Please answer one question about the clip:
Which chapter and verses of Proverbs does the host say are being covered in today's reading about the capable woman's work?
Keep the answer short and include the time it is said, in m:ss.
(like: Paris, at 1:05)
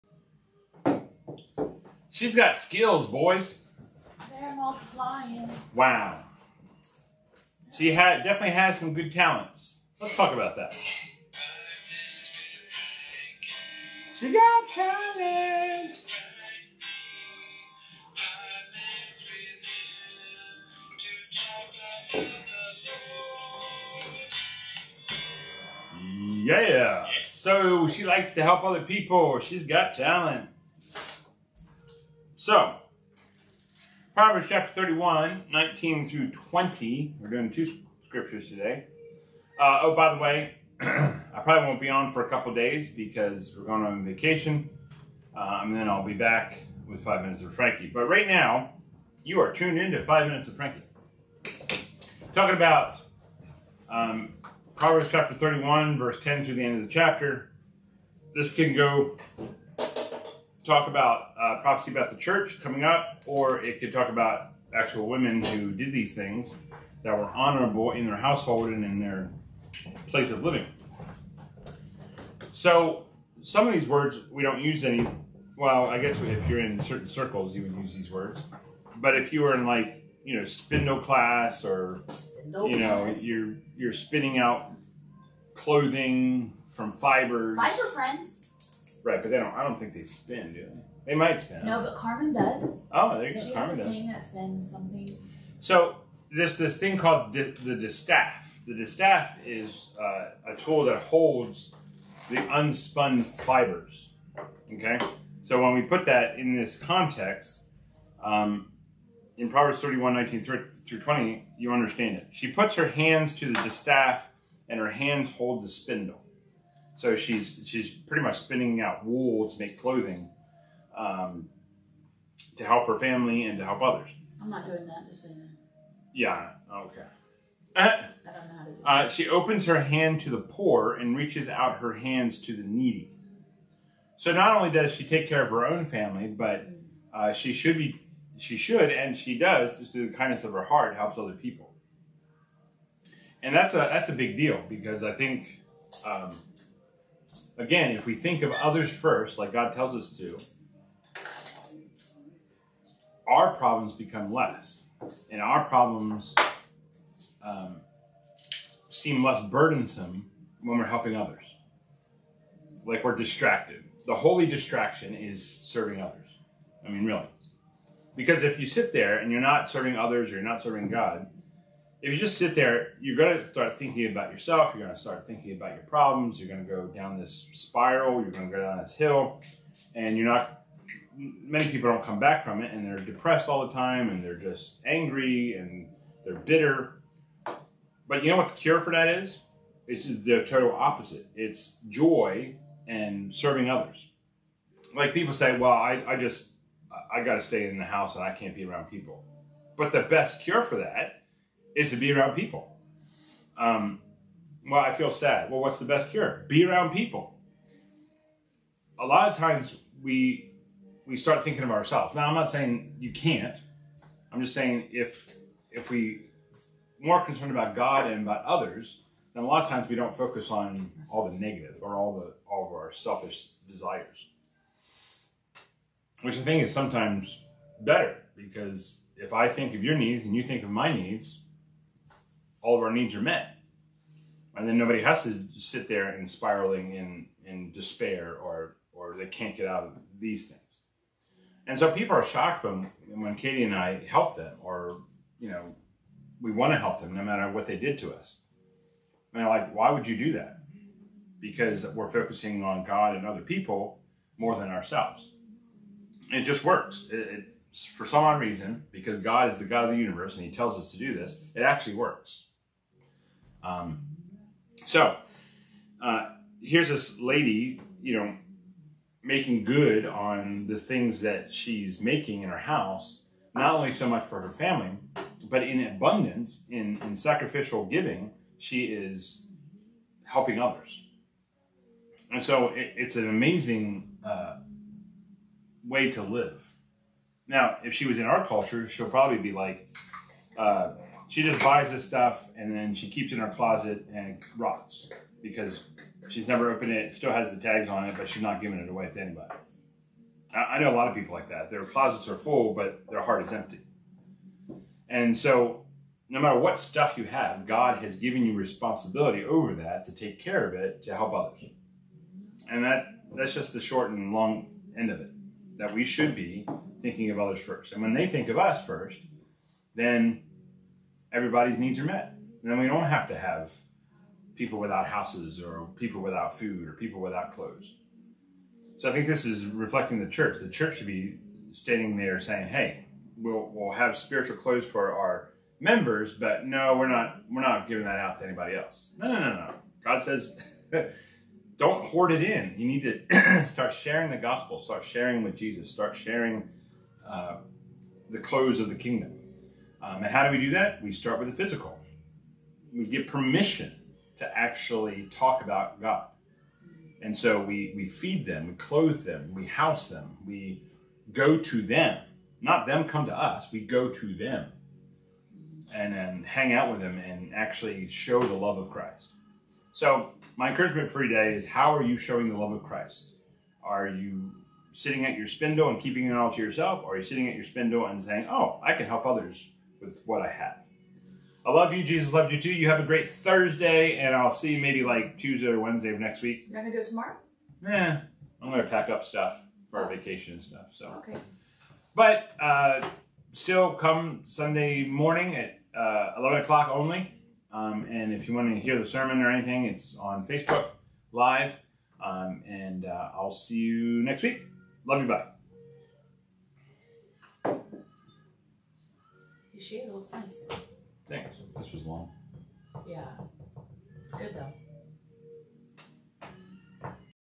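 Proverbs 31:19-20, at 0:34.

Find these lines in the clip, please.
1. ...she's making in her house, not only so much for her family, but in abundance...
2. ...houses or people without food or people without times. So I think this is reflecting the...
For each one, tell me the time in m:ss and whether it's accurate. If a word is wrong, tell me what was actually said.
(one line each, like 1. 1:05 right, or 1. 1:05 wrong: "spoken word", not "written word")
1. 4:31 right
2. 5:25 wrong: "clothes", not "times".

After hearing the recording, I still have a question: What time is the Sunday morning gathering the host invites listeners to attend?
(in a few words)
11 o'clock.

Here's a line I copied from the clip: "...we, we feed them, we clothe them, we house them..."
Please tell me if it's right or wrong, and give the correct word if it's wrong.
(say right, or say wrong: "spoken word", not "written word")
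right.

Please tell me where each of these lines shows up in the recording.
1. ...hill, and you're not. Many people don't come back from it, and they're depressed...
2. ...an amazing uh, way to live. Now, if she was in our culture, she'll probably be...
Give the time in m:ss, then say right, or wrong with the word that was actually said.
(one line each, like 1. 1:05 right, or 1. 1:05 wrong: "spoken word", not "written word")
1. 2:58 right
2. 4:43 right.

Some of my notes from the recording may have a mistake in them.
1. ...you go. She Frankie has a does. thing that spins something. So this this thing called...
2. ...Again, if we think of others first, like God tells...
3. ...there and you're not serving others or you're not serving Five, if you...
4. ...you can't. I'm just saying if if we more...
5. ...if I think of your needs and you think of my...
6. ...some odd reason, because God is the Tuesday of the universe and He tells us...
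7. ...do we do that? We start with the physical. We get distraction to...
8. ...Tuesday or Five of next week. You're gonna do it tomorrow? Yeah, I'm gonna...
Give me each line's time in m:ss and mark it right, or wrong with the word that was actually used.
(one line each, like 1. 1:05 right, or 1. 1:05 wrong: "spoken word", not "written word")
1. 1:33 wrong: "Carmen", not "Frankie"
2. 2:27 right
3. 2:48 wrong: "God", not "Five"
4. 3:32 right
5. 3:49 right
6. 4:18 wrong: "God", not "Tuesday"
7. 5:50 wrong: "permission", not "distraction"
8. 6:25 wrong: "Wednesday", not "Five".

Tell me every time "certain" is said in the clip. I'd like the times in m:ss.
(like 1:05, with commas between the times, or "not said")
1:16.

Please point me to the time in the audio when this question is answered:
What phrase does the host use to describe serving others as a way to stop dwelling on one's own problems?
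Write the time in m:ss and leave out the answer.
2:44.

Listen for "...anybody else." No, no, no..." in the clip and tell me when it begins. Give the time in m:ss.
5:38.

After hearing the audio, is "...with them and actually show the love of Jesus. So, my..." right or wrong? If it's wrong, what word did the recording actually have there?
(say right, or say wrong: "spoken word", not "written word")
wrong: "Christ", not "Jesus".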